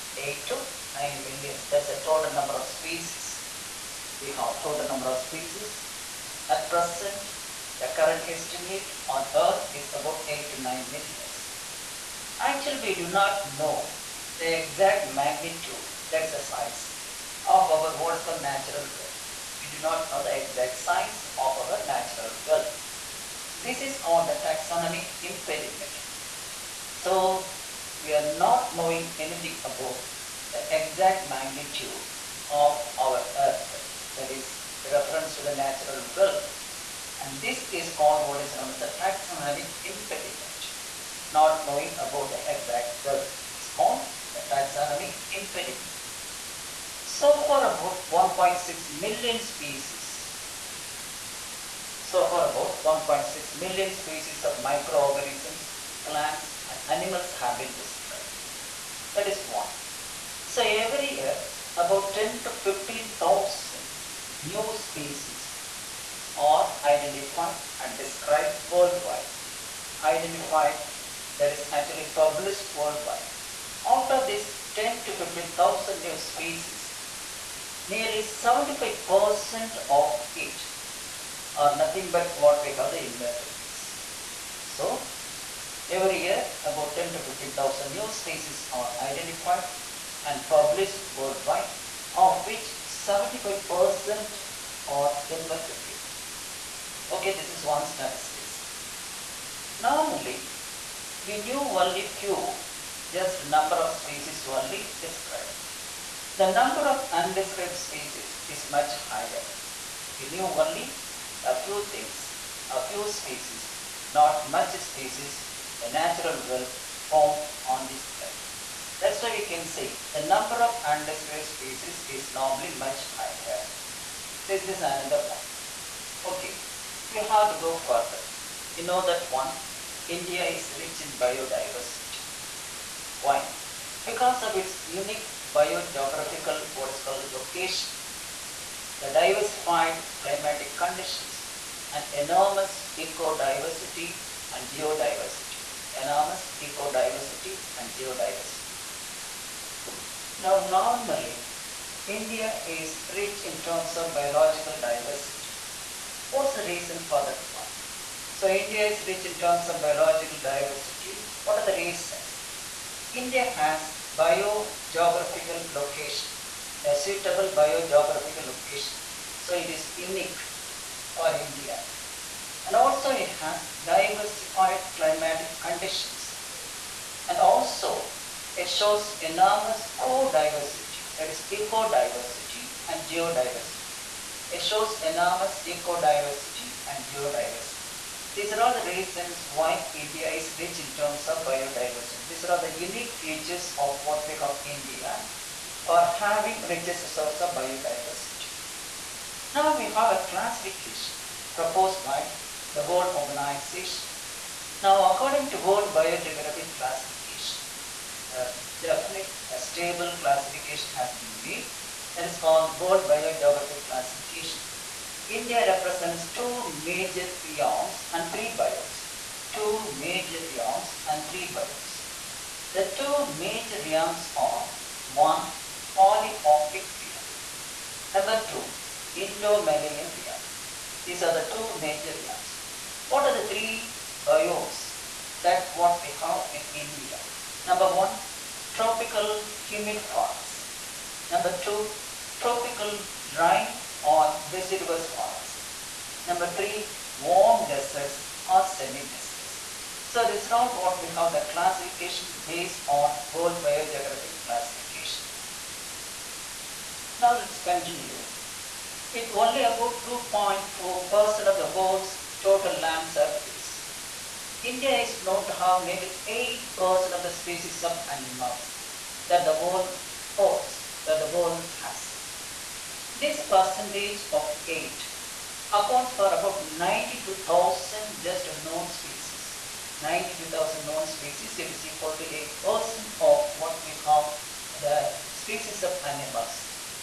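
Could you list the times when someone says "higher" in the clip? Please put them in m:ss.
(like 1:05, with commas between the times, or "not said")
1:48, 2:03.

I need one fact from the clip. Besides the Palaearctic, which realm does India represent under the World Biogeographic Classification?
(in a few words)
Indo-Malayan realm.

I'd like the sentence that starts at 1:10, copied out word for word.
Identified that is actually published worldwide.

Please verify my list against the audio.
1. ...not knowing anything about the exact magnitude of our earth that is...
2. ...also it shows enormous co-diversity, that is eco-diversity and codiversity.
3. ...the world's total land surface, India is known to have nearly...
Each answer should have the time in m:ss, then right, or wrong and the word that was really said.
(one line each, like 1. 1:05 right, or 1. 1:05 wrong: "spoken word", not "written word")
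1. 0:28 right
2. 2:57 wrong: "geodiversity", not "codiversity"
3. 4:21 right.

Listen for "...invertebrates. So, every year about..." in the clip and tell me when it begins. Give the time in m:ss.
1:23.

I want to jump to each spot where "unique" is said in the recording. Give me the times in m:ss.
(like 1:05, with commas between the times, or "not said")
2:14, 2:49, 3:12.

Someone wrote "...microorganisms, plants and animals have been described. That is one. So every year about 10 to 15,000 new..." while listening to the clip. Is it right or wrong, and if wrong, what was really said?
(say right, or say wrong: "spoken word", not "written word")
right.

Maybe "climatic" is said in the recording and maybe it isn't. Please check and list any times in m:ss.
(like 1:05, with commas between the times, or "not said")
2:20, 2:54.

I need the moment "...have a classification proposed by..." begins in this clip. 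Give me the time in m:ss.
3:19.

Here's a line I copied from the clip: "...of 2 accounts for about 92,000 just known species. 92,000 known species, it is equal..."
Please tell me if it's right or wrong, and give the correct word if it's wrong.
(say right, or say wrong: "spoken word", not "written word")
wrong: "8", not "2".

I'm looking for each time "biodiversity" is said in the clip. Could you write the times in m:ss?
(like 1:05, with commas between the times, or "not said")
2:11, 3:11, 3:17.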